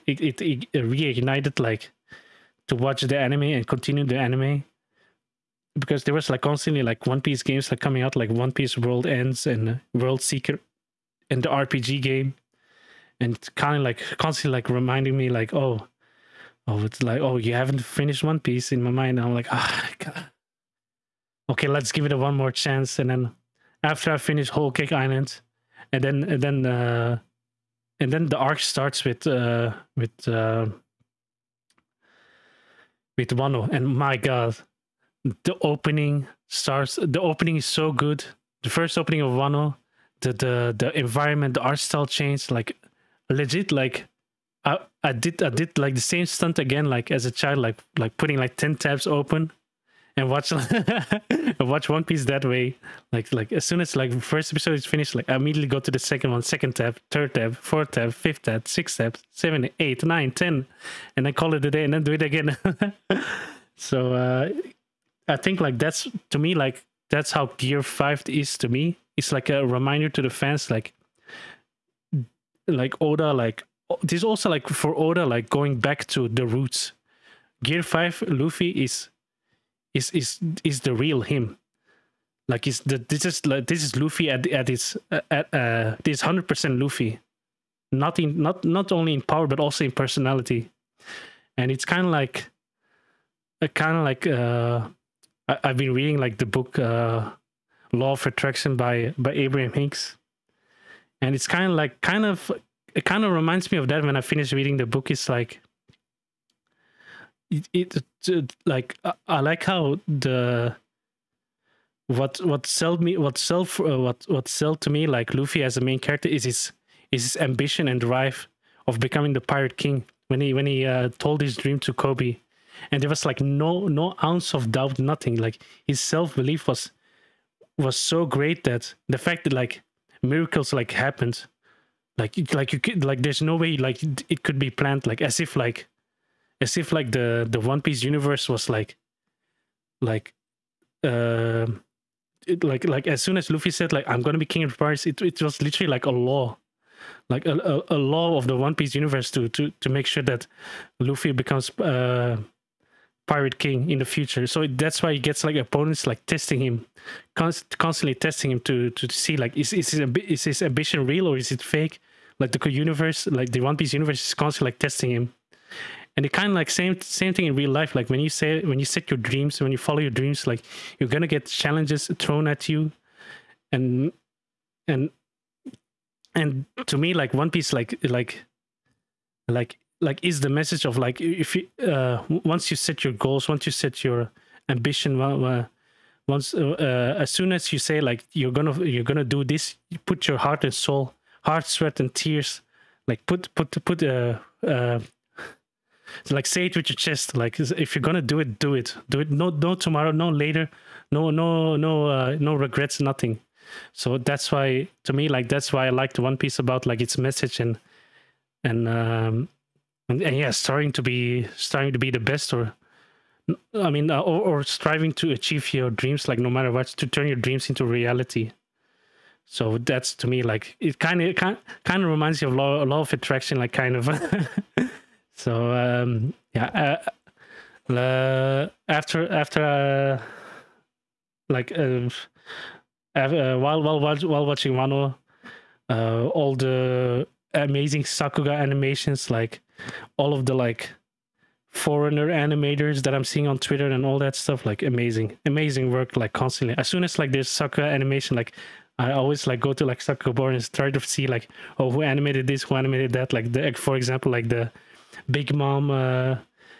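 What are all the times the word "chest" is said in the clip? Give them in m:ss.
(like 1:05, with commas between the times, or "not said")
3:16.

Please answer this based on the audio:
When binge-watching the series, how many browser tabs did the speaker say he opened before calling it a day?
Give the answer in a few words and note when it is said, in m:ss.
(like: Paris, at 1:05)
10, at 1:00.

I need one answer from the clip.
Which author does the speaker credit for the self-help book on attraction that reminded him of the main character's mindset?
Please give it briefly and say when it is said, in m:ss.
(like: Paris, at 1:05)
Abraham Hicks, at 1:39.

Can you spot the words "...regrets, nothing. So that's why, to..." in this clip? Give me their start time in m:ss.
3:22.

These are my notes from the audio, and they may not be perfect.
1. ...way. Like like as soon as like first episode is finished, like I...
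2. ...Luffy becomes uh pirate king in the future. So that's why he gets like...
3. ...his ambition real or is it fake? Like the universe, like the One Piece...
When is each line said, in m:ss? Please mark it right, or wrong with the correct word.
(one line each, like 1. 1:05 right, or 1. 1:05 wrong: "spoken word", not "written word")
1. 0:52 right
2. 2:30 right
3. 2:40 right.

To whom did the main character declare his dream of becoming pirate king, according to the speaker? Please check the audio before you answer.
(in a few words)
Koby.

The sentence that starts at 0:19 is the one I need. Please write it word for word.
I'm like, ah, oh, okay, let's give it a one more chance.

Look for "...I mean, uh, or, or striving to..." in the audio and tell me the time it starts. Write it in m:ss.
3:33.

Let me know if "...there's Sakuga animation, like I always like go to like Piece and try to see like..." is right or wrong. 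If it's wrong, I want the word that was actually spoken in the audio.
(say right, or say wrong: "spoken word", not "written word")
wrong: "Sakugabooru", not "Piece".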